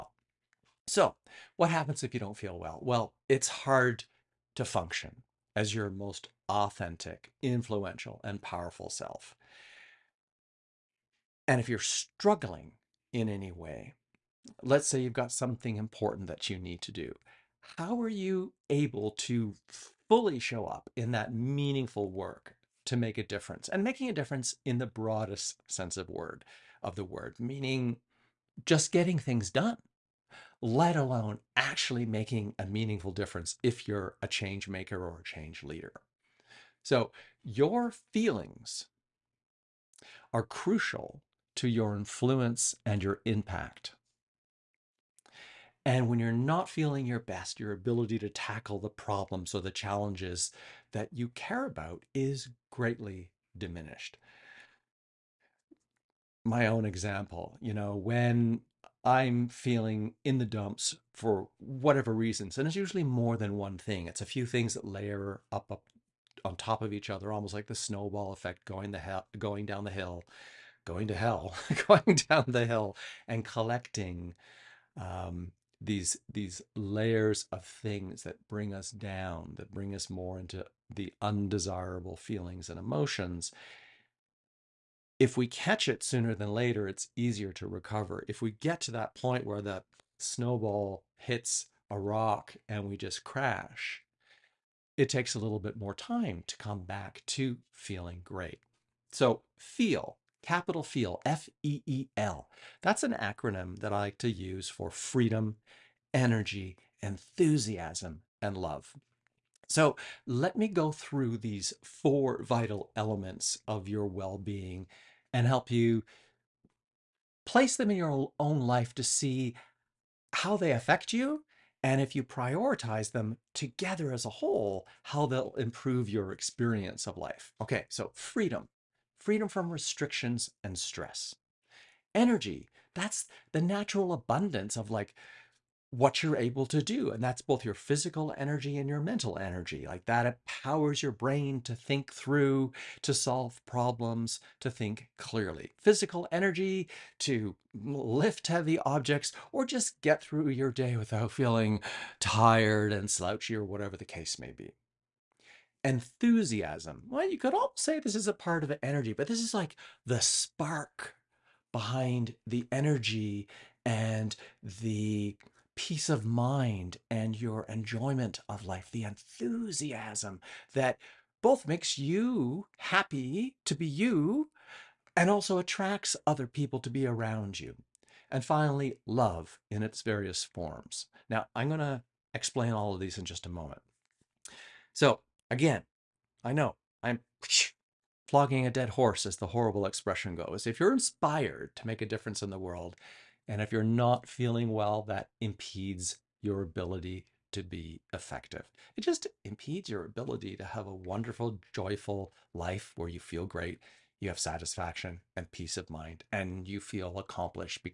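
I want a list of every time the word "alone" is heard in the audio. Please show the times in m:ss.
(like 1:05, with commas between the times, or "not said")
0:30.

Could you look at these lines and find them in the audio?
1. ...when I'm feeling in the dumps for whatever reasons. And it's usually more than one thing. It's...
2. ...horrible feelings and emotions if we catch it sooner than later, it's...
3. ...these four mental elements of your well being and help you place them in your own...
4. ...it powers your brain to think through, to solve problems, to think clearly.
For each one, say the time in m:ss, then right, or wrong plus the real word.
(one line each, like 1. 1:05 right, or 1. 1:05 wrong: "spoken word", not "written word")
1. 0:57 right
2. 1:21 wrong: "undesirable", not "horrible"
3. 1:51 wrong: "vital", not "mental"
4. 2:20 right.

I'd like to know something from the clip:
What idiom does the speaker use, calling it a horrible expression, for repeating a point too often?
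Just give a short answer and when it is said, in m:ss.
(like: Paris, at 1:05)
flogging a dead horse, at 3:08.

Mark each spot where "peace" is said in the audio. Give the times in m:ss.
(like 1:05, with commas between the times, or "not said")
2:45, 3:25.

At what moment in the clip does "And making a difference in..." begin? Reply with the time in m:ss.
0:23.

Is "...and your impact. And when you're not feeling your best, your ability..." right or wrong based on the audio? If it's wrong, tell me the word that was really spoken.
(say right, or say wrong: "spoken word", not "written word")
right.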